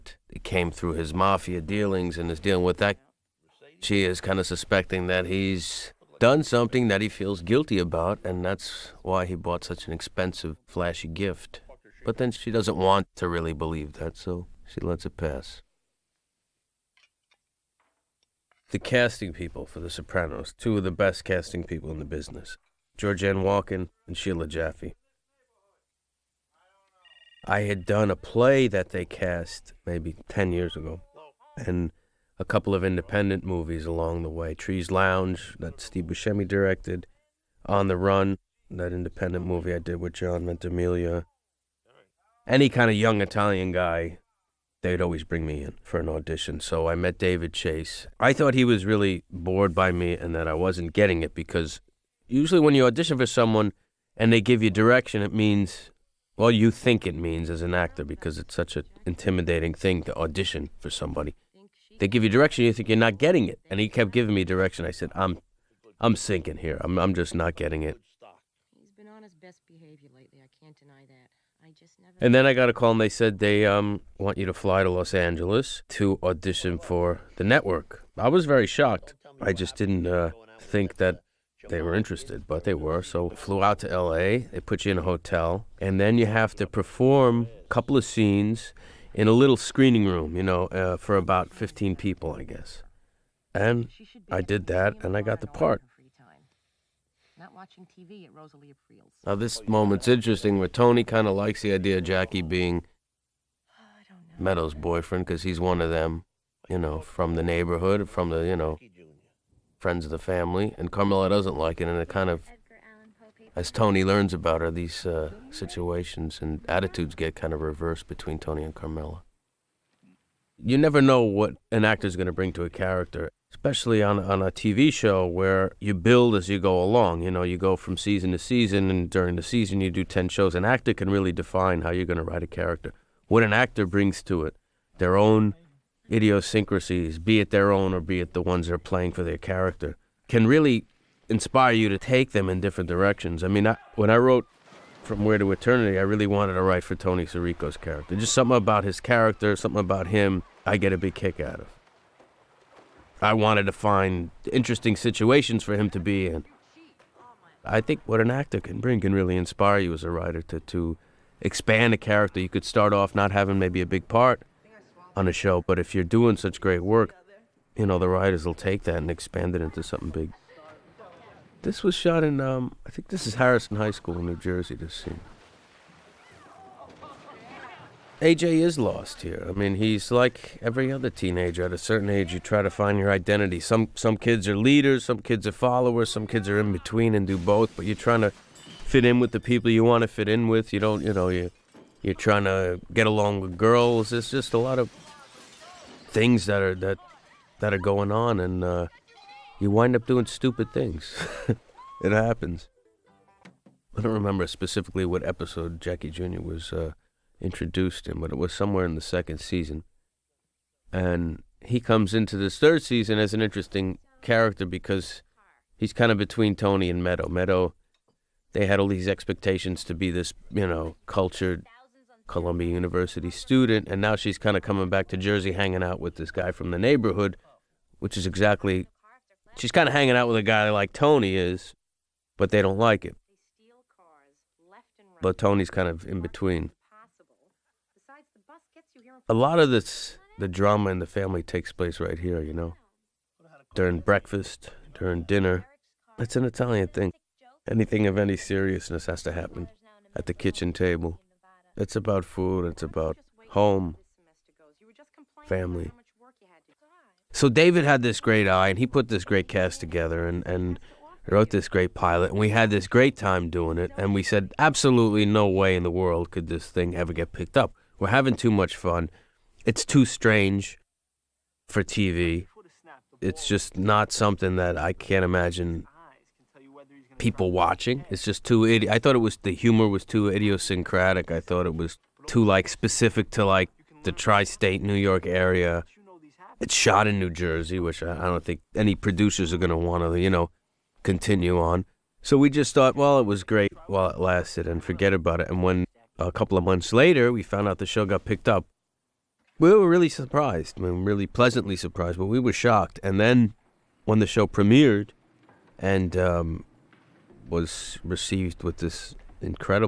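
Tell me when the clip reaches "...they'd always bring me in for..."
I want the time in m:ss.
0:44.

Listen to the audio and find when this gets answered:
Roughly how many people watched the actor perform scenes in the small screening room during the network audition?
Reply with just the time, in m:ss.
1:31.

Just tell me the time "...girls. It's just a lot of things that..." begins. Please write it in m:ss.
3:13.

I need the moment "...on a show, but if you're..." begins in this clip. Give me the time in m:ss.
2:45.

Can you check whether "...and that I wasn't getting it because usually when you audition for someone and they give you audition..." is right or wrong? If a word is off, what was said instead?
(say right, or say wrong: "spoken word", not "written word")
wrong: "direction", not "audition".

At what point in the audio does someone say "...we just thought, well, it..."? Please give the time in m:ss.
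4:52.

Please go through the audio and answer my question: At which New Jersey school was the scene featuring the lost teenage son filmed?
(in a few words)
Harrison High School.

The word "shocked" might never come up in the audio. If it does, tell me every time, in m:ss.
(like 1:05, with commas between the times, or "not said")
1:18, 5:02.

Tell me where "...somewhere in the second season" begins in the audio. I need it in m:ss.
3:28.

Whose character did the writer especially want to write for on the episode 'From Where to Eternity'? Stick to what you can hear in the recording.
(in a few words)
Tony Sirico.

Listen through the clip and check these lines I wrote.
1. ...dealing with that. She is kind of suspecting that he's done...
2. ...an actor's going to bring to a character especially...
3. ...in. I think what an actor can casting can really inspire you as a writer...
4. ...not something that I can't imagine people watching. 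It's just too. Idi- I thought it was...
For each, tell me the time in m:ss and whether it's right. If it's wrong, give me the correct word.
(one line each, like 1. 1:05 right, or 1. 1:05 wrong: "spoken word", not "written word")
1. 0:02 right
2. 2:01 right
3. 2:36 wrong: "bring", not "casting"
4. 4:33 right.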